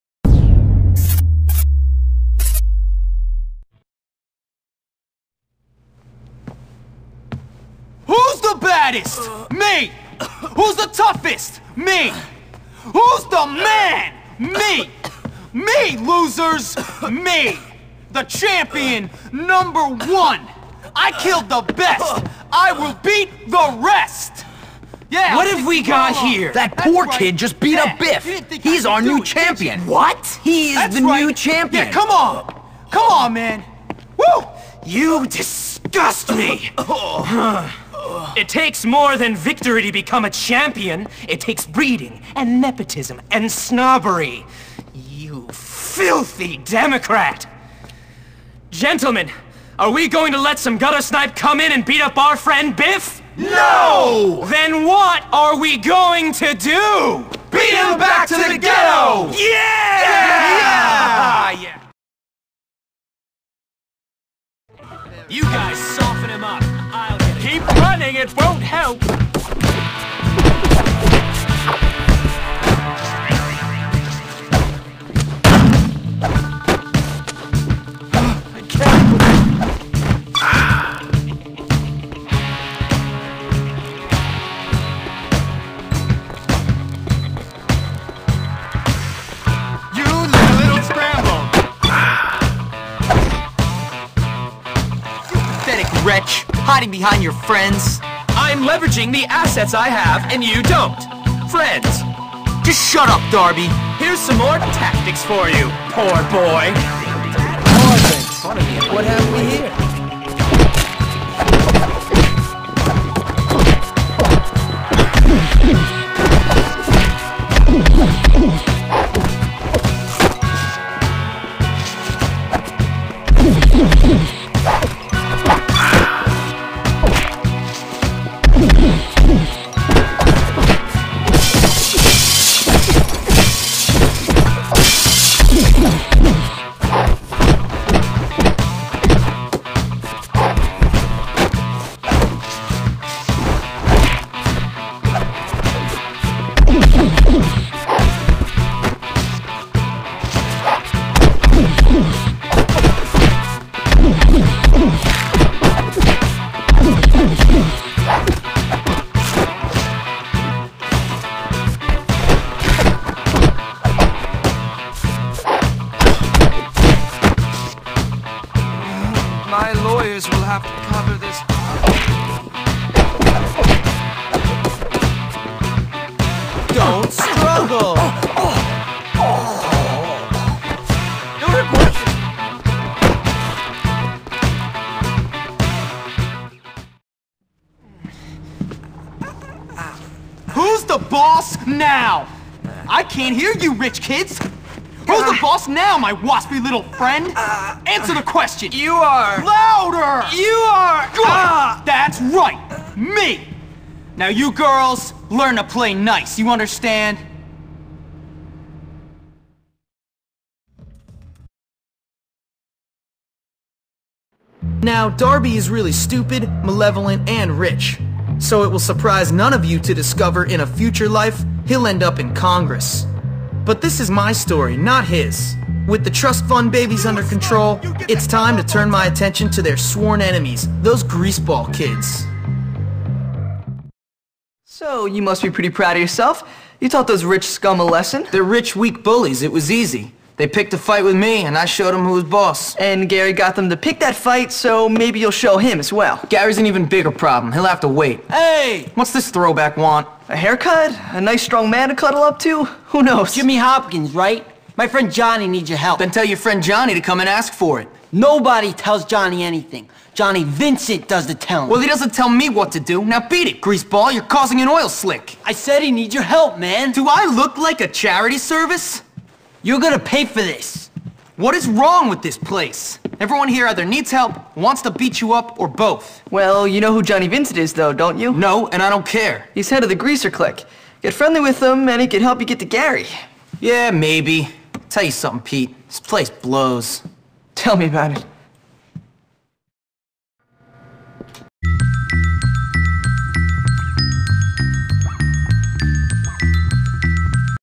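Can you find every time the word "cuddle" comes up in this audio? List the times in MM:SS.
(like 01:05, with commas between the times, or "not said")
04:11.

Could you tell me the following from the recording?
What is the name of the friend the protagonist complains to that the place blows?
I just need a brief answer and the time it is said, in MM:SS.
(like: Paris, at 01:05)
Pete, at 04:45.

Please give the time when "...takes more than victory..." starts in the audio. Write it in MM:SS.
00:38.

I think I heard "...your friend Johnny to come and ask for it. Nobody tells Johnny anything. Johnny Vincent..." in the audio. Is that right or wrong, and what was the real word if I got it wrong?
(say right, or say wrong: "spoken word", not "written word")
right.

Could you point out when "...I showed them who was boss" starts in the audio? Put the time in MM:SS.
04:01.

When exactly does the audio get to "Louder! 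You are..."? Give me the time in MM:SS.
03:19.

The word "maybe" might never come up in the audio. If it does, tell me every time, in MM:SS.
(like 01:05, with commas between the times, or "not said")
04:04, 04:43.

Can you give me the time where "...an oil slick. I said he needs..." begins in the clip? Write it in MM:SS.
04:24.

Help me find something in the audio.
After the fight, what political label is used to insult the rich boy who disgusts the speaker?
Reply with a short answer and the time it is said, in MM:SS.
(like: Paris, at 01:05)
Democrat, at 00:46.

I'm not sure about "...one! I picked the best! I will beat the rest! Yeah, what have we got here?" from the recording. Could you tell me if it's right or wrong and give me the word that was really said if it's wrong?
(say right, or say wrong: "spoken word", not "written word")
wrong: "killed", not "picked".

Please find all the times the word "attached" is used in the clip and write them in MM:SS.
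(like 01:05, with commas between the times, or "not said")
not said.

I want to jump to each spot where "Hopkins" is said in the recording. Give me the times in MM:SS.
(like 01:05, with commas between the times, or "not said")
04:13.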